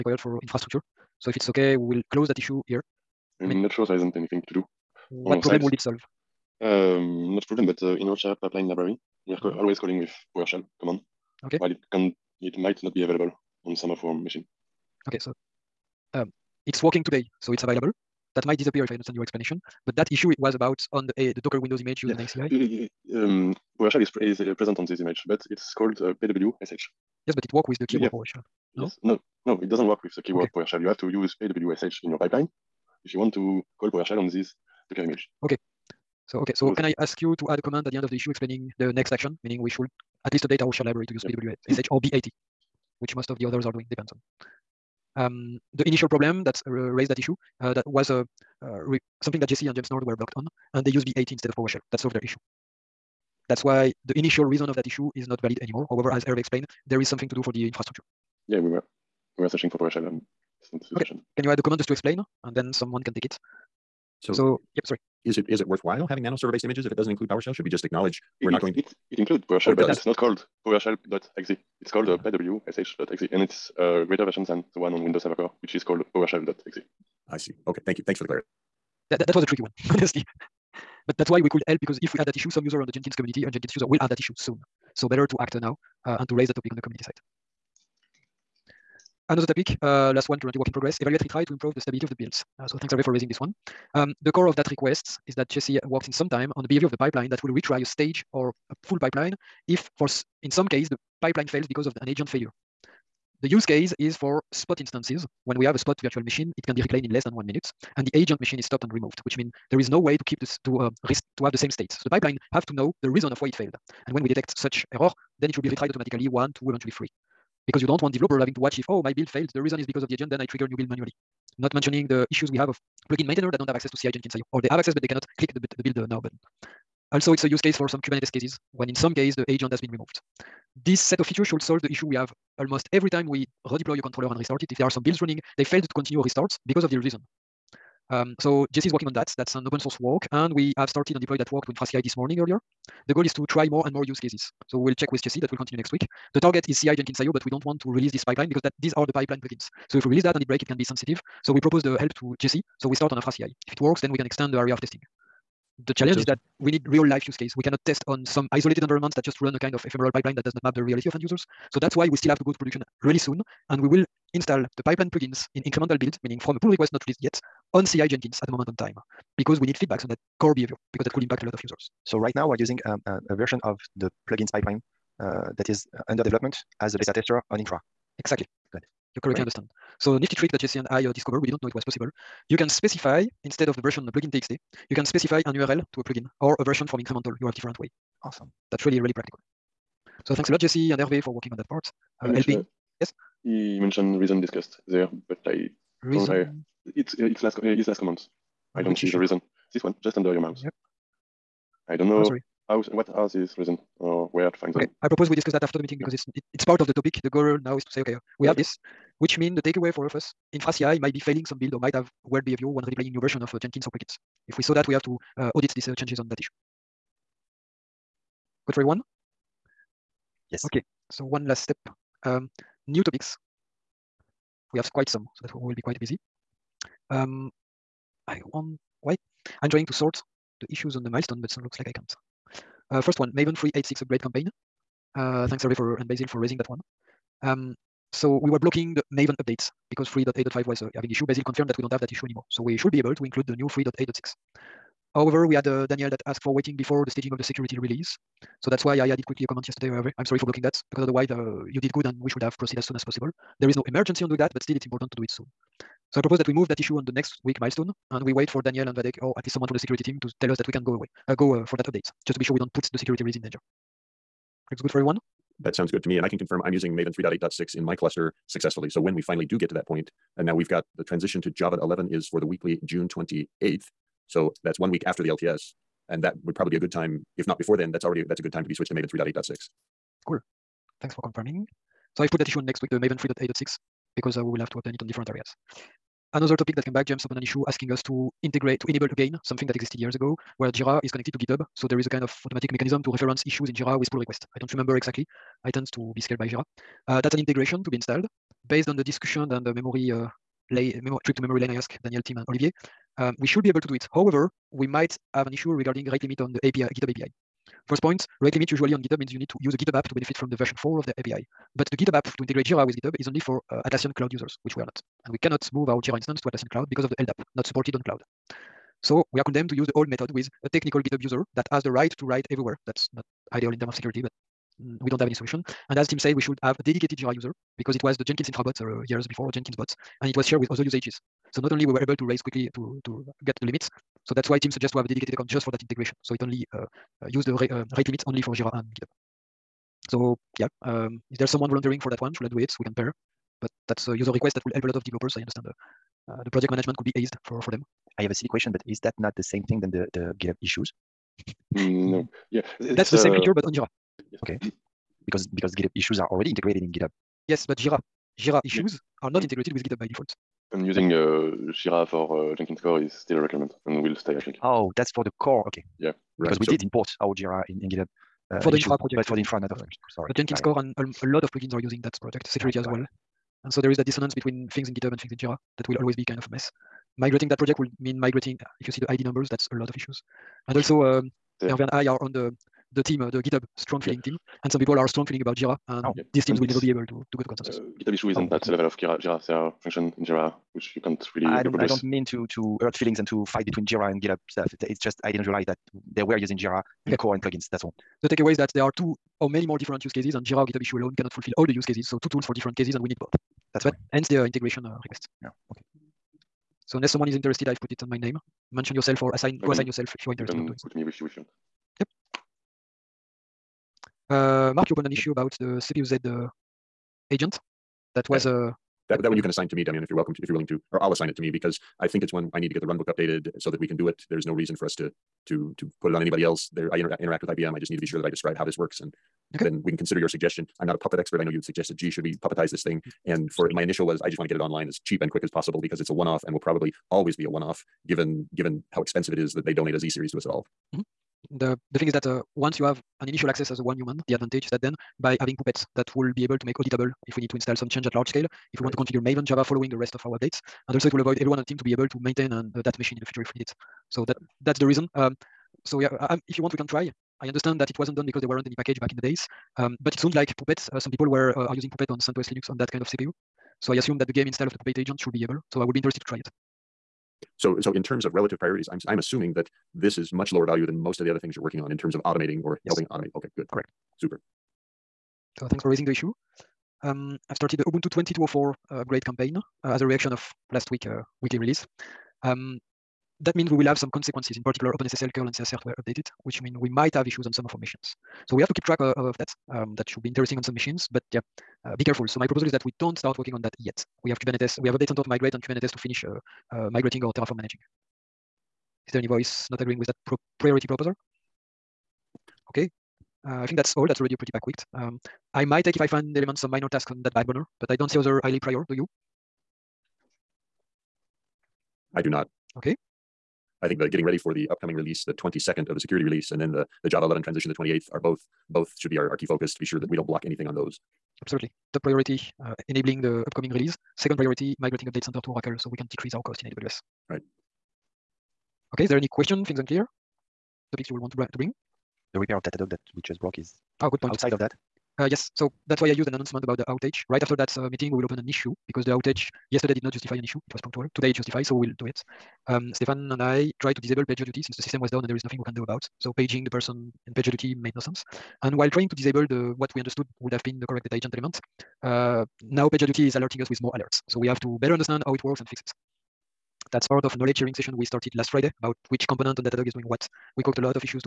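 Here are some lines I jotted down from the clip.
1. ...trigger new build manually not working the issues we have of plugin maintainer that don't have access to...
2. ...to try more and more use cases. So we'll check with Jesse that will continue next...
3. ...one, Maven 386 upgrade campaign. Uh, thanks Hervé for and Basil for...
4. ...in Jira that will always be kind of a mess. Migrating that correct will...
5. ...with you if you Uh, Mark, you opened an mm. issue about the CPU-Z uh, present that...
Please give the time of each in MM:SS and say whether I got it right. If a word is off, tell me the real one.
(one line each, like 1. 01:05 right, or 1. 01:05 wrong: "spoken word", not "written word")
1. 02:00 wrong: "mentioning", not "working"
2. 02:23 right
3. 03:53 right
4. 06:15 wrong: "project", not "correct"
5. 06:51 wrong: "agent", not "present".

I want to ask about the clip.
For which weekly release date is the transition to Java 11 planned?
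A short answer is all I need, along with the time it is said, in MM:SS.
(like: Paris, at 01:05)
June 28th, at 04:32.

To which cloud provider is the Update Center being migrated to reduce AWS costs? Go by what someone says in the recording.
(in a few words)
Oracle.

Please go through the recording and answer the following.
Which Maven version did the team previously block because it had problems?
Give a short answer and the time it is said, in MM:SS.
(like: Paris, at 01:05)
3.8.5, at 04:00.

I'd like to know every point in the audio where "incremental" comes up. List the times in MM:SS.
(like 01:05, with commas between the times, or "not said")
02:45, 03:06.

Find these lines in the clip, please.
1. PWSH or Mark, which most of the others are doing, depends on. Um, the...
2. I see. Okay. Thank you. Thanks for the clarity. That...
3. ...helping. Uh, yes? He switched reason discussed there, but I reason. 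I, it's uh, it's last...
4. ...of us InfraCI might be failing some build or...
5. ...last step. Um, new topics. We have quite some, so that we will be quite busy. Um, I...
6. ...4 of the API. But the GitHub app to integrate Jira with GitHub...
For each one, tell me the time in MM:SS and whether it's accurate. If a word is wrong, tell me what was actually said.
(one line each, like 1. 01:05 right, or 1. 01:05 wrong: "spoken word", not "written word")
1. 00:41 wrong: "BAT", not "Mark"
2. 01:17 right
3. 03:12 wrong: "mentioned", not "switched"
4. 03:30 right
5. 03:41 right
6. 05:10 right.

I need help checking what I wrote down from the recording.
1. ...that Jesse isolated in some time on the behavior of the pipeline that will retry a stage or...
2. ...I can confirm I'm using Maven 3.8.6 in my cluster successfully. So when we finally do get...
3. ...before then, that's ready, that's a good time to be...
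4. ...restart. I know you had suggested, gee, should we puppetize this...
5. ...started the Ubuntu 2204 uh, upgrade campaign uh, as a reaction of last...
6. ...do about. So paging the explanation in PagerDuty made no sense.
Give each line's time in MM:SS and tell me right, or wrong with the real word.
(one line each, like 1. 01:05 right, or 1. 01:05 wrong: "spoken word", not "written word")
1. 01:35 wrong: "worked", not "isolated"
2. 04:26 right
3. 04:37 wrong: "already", not "ready"
4. 07:11 wrong: "expert", not "restart"
5. 07:57 right
6. 09:05 wrong: "person", not "explanation".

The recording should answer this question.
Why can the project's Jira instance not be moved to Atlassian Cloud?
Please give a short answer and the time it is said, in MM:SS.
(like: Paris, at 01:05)
LDAP, at 05:17.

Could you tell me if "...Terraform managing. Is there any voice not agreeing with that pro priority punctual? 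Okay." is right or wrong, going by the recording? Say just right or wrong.
wrong.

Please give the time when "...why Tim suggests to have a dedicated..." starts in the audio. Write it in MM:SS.
05:34.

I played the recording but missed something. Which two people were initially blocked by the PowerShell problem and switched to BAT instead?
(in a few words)
Jesse and James Nord.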